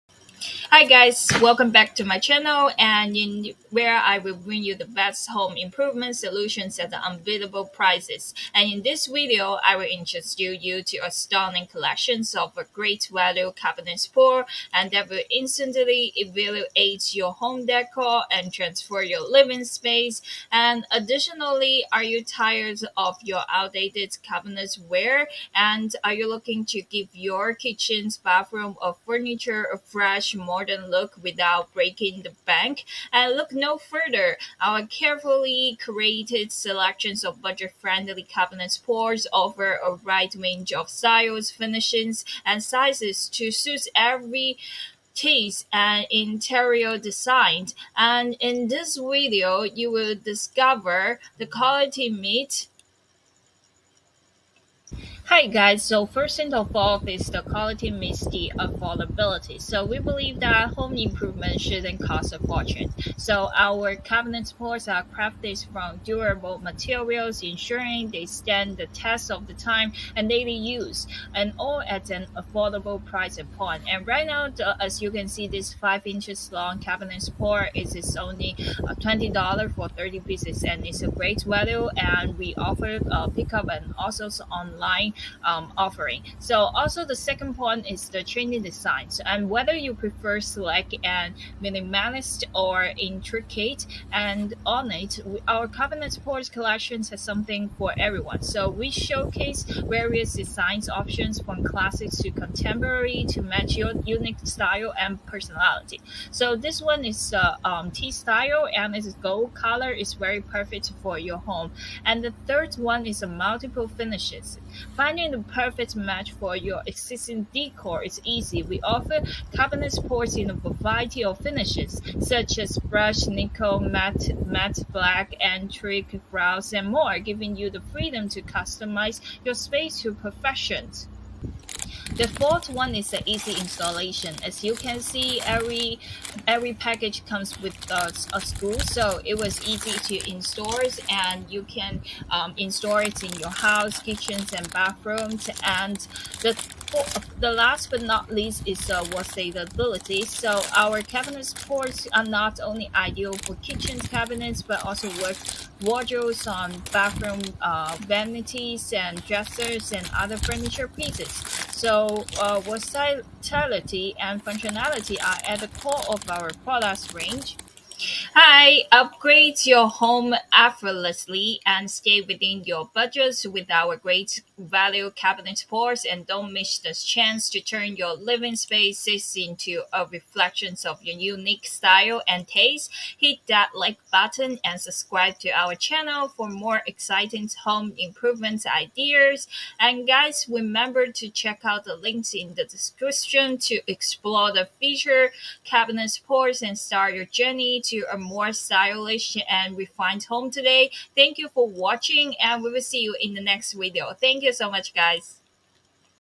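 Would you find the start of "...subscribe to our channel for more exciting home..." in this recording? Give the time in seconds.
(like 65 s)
184 s.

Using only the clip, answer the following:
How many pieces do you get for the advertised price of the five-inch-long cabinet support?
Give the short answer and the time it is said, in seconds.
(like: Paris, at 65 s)
30, at 79 s.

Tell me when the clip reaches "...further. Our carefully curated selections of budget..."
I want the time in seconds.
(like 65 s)
33 s.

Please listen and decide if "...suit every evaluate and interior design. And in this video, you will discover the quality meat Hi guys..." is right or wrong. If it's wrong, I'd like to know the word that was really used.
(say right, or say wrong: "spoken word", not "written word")
wrong: "taste", not "evaluate".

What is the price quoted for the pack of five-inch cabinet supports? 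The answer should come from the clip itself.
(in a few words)
$20.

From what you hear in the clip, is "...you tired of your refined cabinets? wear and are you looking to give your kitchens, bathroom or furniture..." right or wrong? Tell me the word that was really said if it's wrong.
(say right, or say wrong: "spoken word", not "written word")
wrong: "outdated", not "refined".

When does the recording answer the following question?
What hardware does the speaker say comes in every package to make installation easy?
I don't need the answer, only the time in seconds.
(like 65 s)
138 s.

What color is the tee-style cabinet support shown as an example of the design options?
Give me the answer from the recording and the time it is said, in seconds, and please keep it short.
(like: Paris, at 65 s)
Gold, at 109 s.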